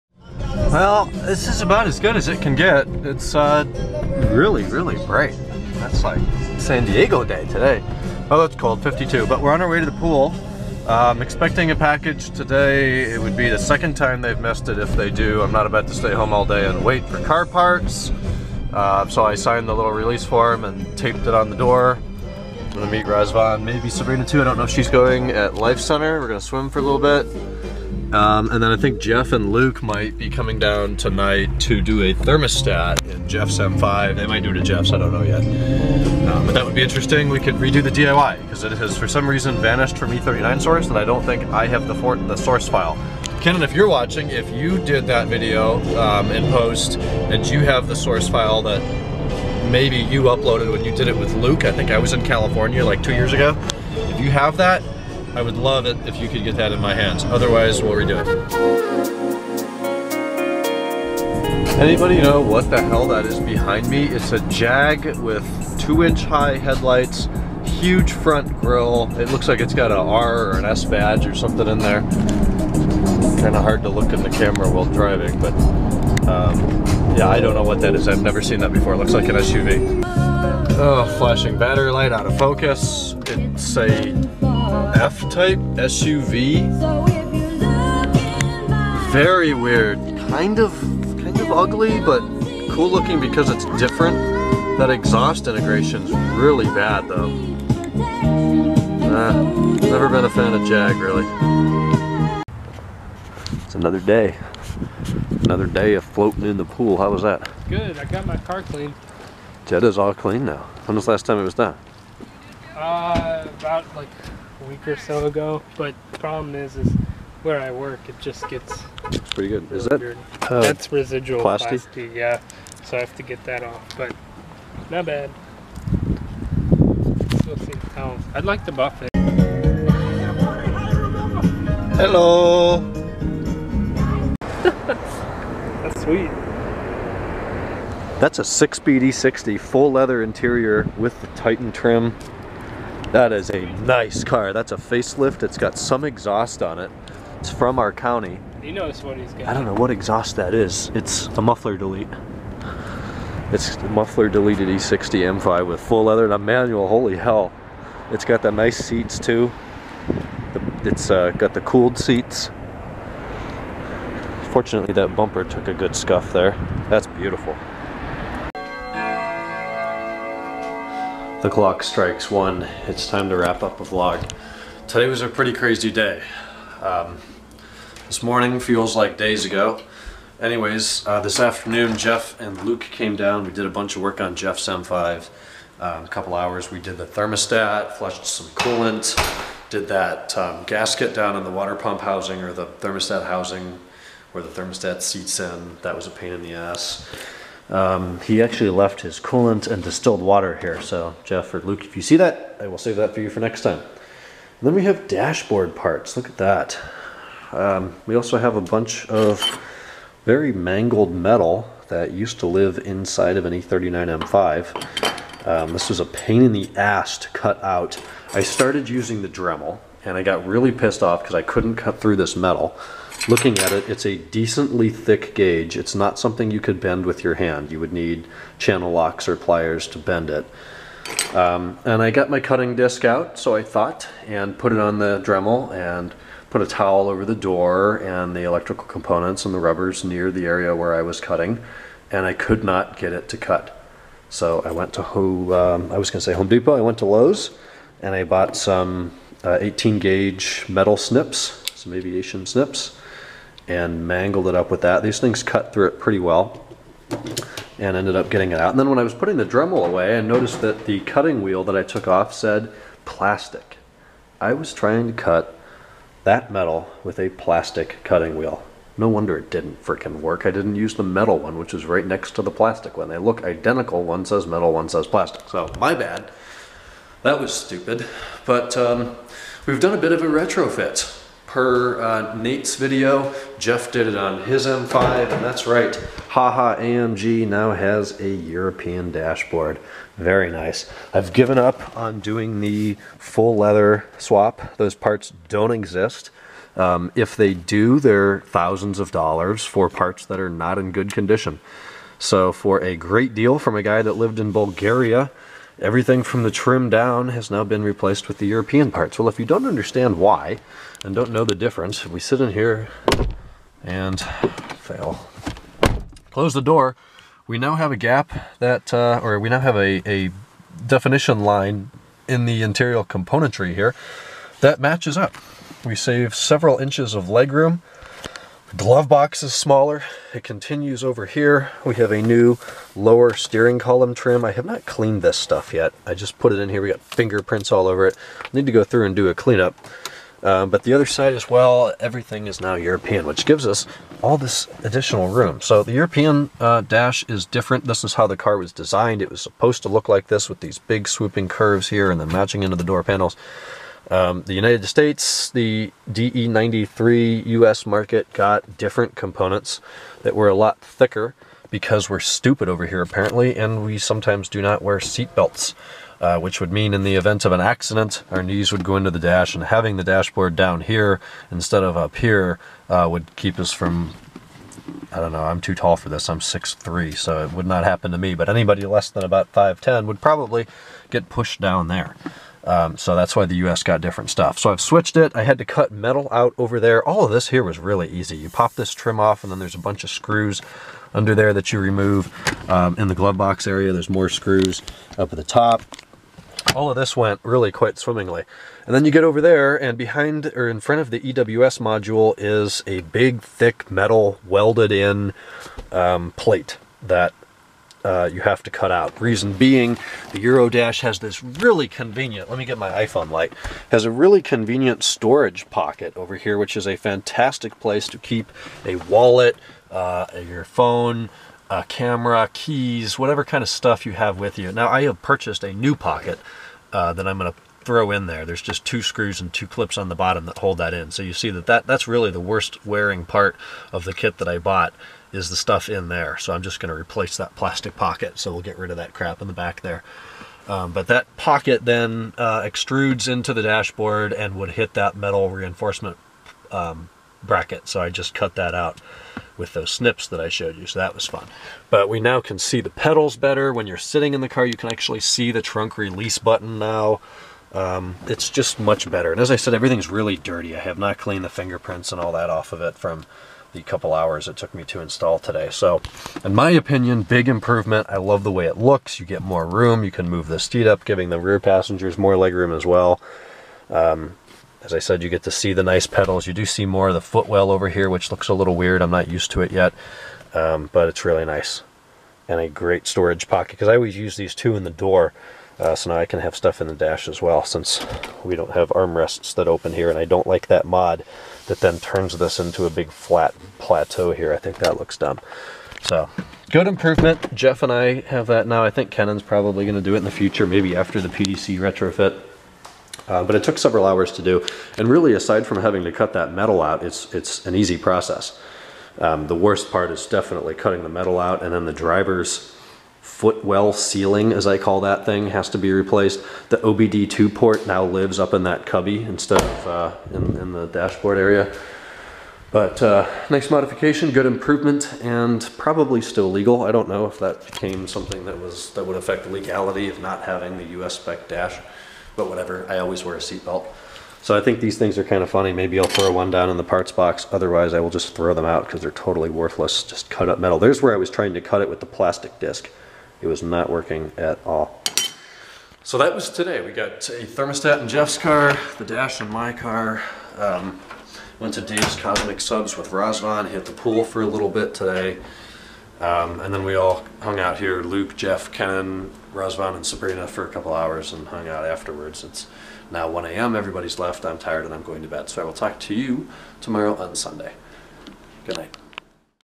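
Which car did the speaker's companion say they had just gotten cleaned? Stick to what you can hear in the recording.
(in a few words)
Jetta.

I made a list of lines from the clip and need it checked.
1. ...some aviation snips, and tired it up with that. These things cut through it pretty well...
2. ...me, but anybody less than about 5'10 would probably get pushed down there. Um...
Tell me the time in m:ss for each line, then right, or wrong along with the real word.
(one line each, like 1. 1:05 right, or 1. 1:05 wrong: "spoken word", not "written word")
1. 4:11 wrong: "mangled", not "tired"
2. 6:18 right.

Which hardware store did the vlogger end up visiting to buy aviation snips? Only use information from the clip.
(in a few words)
Lowe's.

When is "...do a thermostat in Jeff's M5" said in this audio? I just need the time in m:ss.
0:31.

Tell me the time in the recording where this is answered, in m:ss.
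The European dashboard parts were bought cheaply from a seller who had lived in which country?
5:04.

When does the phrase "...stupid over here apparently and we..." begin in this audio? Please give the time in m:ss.
6:02.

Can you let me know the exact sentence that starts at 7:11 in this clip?
So you see that, that that's really the worst wearing part of the kit that I bought is the stuff in there.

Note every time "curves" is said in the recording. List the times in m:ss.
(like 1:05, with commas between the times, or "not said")
5:51.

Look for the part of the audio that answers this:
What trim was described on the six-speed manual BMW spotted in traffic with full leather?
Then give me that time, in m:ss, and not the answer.
2:21.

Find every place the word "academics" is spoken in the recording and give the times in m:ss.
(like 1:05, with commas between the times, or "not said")
not said.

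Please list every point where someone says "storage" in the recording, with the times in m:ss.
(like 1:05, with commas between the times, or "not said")
6:55, 8:03.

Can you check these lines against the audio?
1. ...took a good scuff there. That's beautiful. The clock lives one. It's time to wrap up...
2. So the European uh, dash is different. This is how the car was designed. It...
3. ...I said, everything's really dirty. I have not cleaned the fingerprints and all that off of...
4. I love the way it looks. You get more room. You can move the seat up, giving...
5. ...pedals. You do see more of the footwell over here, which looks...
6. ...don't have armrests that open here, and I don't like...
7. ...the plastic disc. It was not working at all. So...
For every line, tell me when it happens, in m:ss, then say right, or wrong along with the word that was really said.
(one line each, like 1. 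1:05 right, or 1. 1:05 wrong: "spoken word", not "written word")
1. 2:45 wrong: "strikes", not "lives"
2. 5:45 right
3. 7:39 right
4. 7:48 right
5. 7:56 right
6. 8:08 right
7. 9:01 right.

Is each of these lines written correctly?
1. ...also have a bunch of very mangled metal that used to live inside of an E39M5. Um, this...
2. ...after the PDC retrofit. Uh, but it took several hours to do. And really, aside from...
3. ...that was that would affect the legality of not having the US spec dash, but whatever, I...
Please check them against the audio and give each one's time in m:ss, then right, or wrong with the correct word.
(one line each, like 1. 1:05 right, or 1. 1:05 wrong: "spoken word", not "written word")
1. 3:28 right
2. 8:20 right
3. 8:48 right.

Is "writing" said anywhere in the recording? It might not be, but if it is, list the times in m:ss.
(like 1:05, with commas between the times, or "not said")
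not said.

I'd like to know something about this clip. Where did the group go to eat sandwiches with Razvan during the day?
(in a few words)
Dave's Cosmic Subs.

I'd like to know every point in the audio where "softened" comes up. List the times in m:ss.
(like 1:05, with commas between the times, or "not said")
not said.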